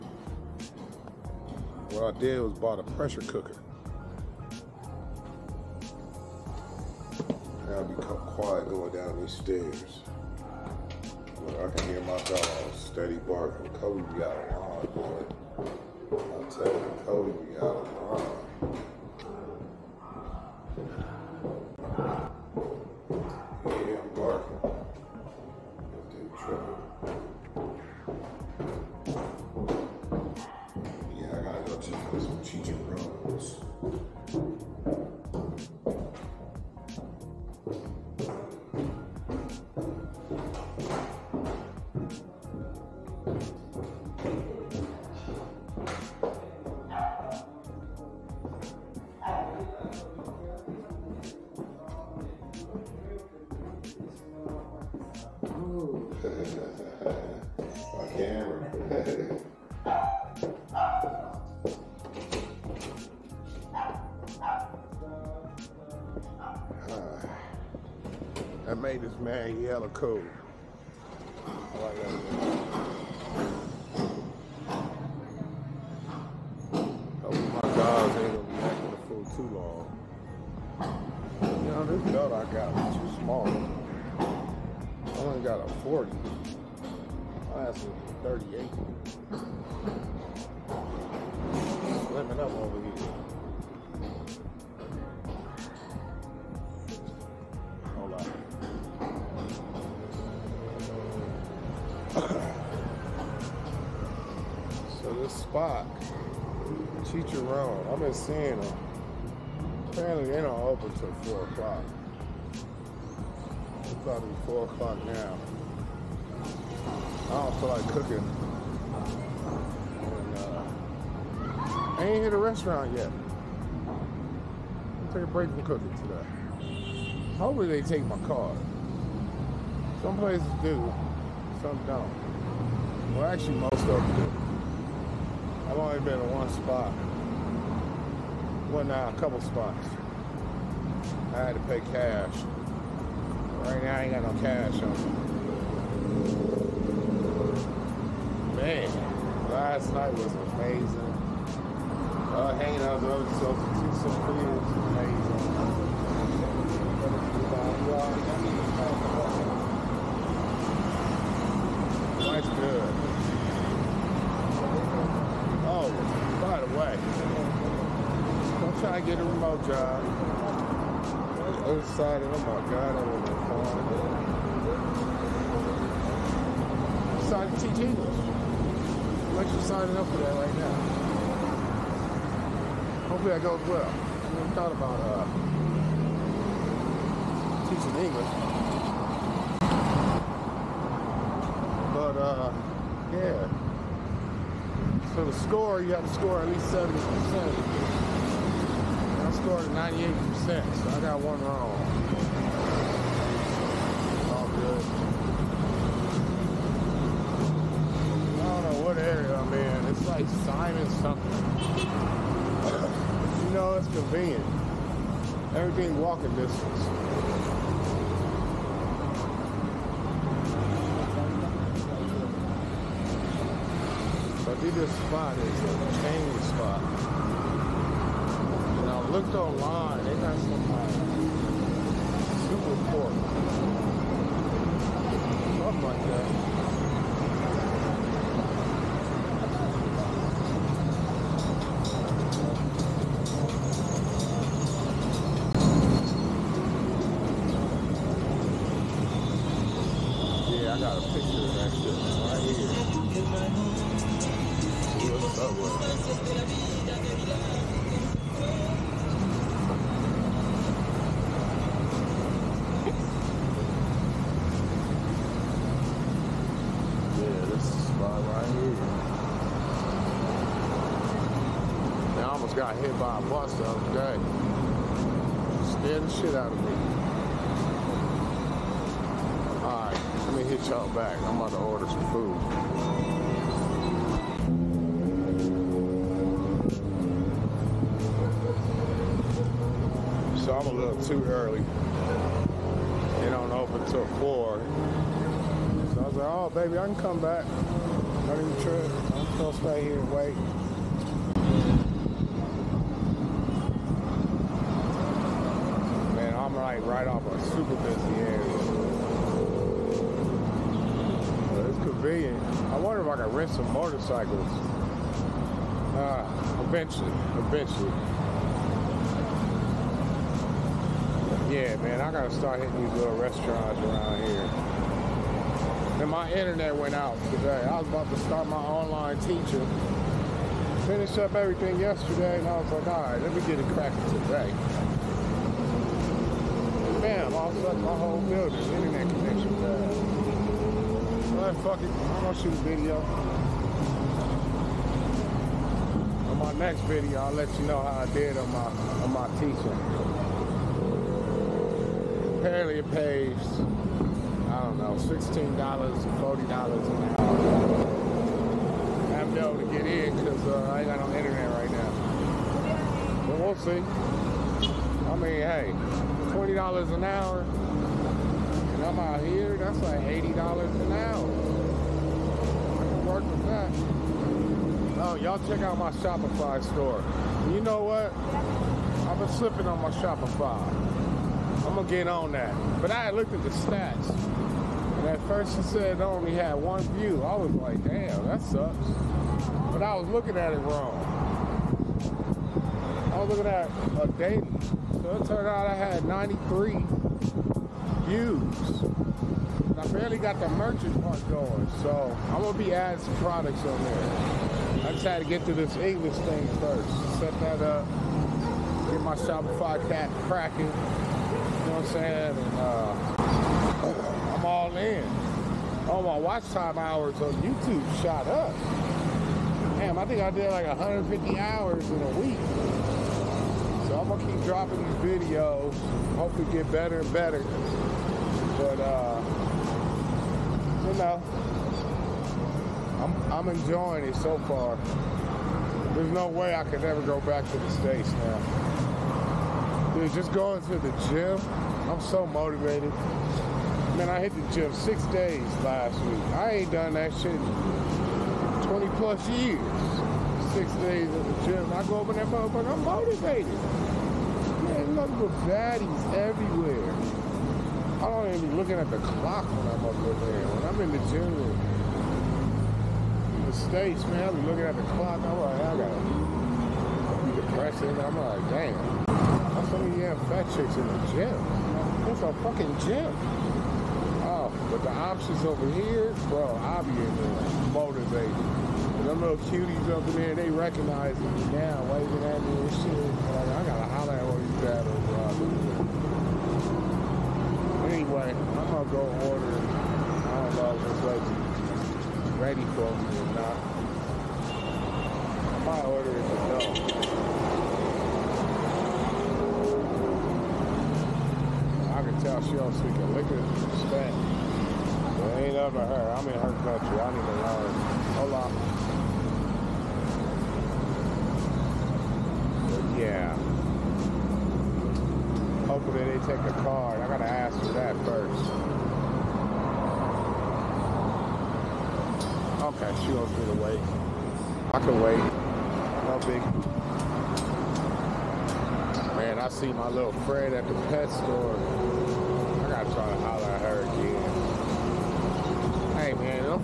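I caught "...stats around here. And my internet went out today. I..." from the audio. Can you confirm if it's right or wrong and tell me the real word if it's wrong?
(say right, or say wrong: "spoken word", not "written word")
wrong: "restaurants", not "stats".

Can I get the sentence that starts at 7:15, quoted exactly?
There's no way I could ever go back to the States now.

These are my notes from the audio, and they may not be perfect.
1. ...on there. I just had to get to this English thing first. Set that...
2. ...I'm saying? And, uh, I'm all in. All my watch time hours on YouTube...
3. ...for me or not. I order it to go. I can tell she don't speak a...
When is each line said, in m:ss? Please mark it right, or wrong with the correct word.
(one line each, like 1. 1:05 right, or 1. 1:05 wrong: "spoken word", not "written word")
1. 6:43 right
2. 6:51 right
3. 8:12 right.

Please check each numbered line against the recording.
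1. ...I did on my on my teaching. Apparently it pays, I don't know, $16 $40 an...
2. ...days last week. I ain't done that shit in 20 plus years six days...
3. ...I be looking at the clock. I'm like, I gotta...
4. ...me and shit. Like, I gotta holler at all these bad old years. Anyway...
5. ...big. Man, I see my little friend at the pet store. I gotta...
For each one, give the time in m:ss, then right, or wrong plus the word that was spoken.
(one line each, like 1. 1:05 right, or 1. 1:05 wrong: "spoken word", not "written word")
1. 5:48 right
2. 7:25 right
3. 7:44 right
4. 8:02 wrong: "robbers", not "years"
5. 8:46 right.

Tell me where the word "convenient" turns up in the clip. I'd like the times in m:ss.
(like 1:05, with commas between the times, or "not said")
3:33, 5:11.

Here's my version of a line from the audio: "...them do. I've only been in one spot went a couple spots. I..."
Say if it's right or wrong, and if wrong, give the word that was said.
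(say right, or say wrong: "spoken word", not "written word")
right.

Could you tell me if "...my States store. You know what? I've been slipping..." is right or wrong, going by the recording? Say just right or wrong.
wrong.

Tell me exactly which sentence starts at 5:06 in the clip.
right off a super busy area.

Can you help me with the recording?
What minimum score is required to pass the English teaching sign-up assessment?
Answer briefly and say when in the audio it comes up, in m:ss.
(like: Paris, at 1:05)
70%, at 3:16.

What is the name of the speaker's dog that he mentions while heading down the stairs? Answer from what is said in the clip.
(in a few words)
Kobe.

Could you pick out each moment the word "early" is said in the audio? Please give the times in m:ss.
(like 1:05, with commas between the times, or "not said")
4:51.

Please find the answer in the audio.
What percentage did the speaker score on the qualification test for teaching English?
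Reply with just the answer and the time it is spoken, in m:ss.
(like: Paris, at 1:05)
98%, at 3:19.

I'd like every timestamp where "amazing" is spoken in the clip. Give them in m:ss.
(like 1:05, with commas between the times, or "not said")
2:30, 2:38.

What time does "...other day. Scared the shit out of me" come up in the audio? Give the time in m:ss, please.
4:33.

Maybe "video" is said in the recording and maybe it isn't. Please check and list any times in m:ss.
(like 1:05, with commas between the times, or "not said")
5:42, 5:46, 7:05.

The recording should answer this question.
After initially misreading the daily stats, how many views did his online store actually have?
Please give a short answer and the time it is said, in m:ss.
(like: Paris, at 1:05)
93, at 6:36.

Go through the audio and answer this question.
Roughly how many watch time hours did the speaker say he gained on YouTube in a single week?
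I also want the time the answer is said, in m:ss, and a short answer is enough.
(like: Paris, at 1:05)
150, at 7:00.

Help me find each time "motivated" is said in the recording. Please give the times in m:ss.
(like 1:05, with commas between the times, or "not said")
7:22, 7:32, 7:57.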